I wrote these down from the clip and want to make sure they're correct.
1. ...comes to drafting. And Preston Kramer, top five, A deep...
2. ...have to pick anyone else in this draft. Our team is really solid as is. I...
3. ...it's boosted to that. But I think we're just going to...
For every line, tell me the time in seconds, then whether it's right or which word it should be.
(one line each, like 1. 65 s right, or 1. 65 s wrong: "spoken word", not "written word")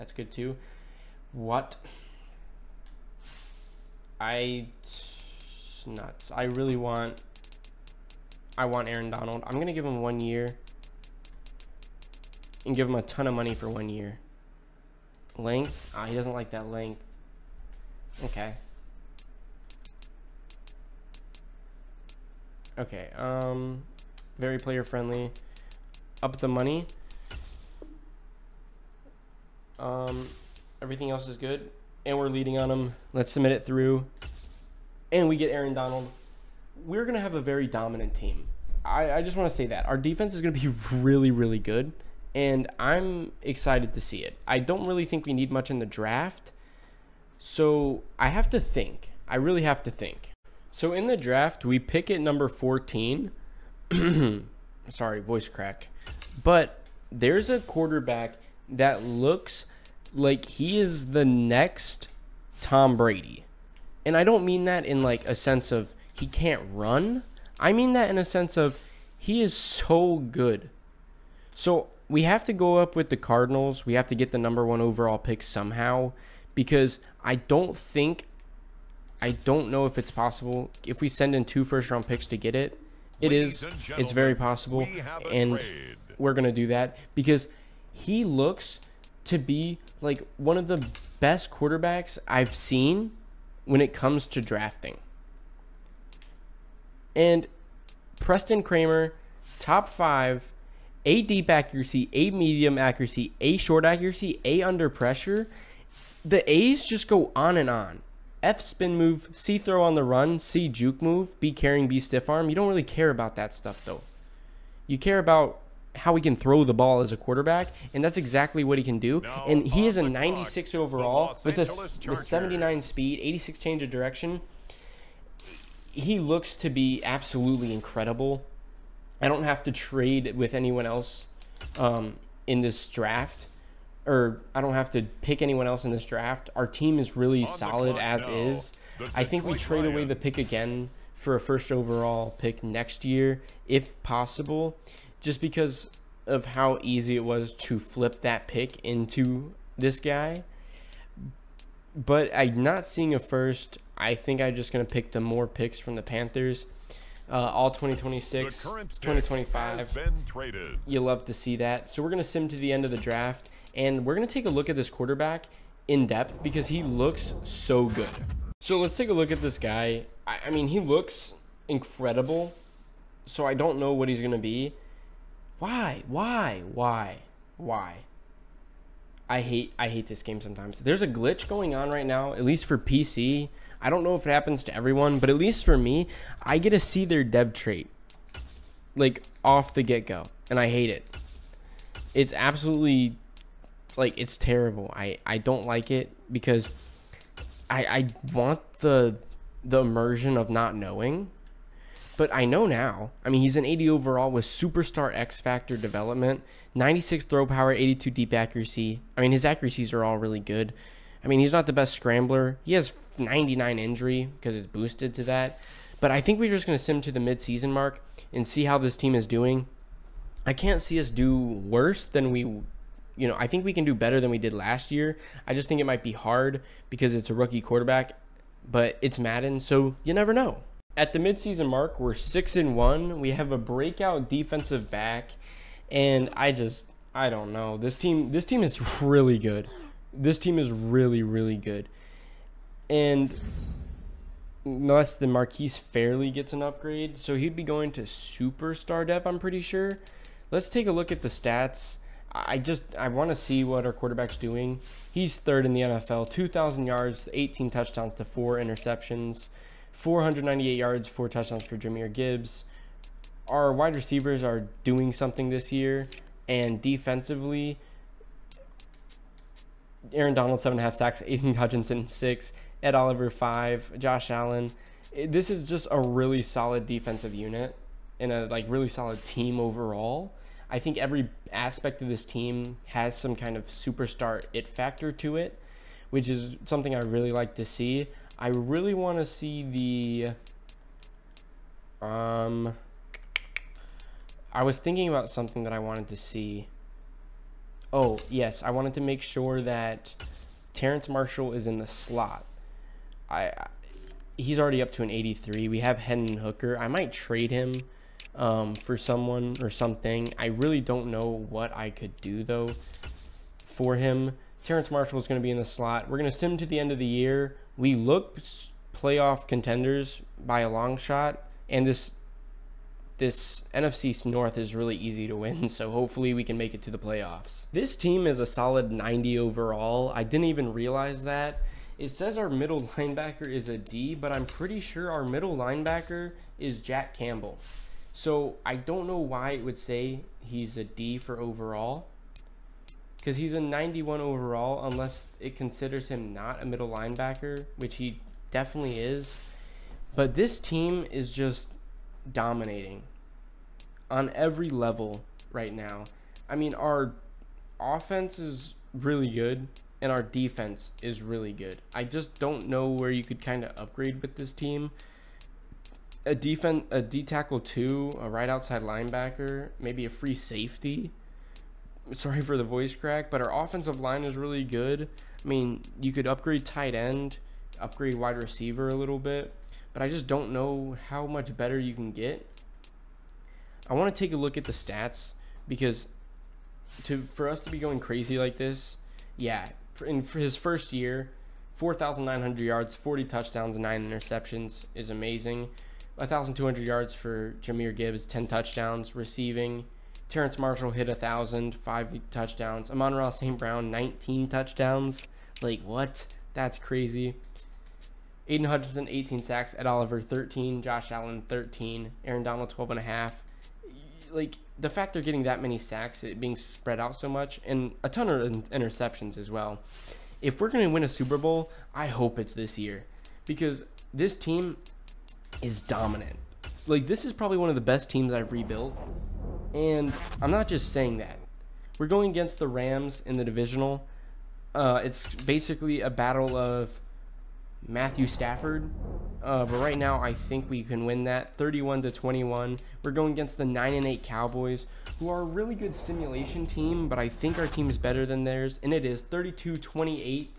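1. 93 s right
2. 134 s right
3. 214 s right.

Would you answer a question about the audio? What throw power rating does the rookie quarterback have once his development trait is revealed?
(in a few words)
96.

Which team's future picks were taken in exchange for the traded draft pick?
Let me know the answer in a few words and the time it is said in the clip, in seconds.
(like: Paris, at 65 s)
Panthers, at 156 s.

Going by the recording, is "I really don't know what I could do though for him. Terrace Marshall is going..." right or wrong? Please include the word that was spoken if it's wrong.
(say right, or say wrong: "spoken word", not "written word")
right.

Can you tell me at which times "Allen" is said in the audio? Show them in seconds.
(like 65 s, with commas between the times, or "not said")
274 s, 411 s.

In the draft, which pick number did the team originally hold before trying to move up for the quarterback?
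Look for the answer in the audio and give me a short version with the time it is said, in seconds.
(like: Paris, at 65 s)
14, at 52 s.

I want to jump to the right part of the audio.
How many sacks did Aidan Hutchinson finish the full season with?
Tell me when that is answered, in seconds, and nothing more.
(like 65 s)
409 s.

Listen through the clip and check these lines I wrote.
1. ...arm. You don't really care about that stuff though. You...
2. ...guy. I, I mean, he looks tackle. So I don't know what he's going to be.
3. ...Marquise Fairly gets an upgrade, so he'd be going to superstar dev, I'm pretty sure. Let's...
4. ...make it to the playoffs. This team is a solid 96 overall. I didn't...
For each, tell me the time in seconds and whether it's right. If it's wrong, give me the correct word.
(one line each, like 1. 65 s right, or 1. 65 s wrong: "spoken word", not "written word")
1. 112 s right
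2. 169 s wrong: "incredible", not "tackle"
3. 245 s right
4. 326 s wrong: "90", not "96".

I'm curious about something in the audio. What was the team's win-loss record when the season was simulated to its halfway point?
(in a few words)
6-1.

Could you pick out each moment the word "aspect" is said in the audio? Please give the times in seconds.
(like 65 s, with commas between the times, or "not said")
281 s.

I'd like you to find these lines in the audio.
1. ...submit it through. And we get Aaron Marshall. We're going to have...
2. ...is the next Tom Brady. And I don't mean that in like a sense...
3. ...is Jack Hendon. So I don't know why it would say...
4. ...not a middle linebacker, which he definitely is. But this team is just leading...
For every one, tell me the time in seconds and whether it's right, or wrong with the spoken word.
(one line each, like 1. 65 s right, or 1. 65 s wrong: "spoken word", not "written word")
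1. 33 s wrong: "Donald", not "Marshall"
2. 60 s right
3. 336 s wrong: "Campbell", not "Hendon"
4. 346 s wrong: "dominating", not "leading".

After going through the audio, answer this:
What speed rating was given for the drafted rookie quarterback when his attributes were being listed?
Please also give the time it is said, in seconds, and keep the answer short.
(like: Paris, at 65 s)
79, at 122 s.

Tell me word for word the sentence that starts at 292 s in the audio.
Um, I was thinking about something that I wanted to see.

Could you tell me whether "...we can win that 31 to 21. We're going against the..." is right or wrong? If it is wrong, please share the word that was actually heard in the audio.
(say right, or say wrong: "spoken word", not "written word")
right.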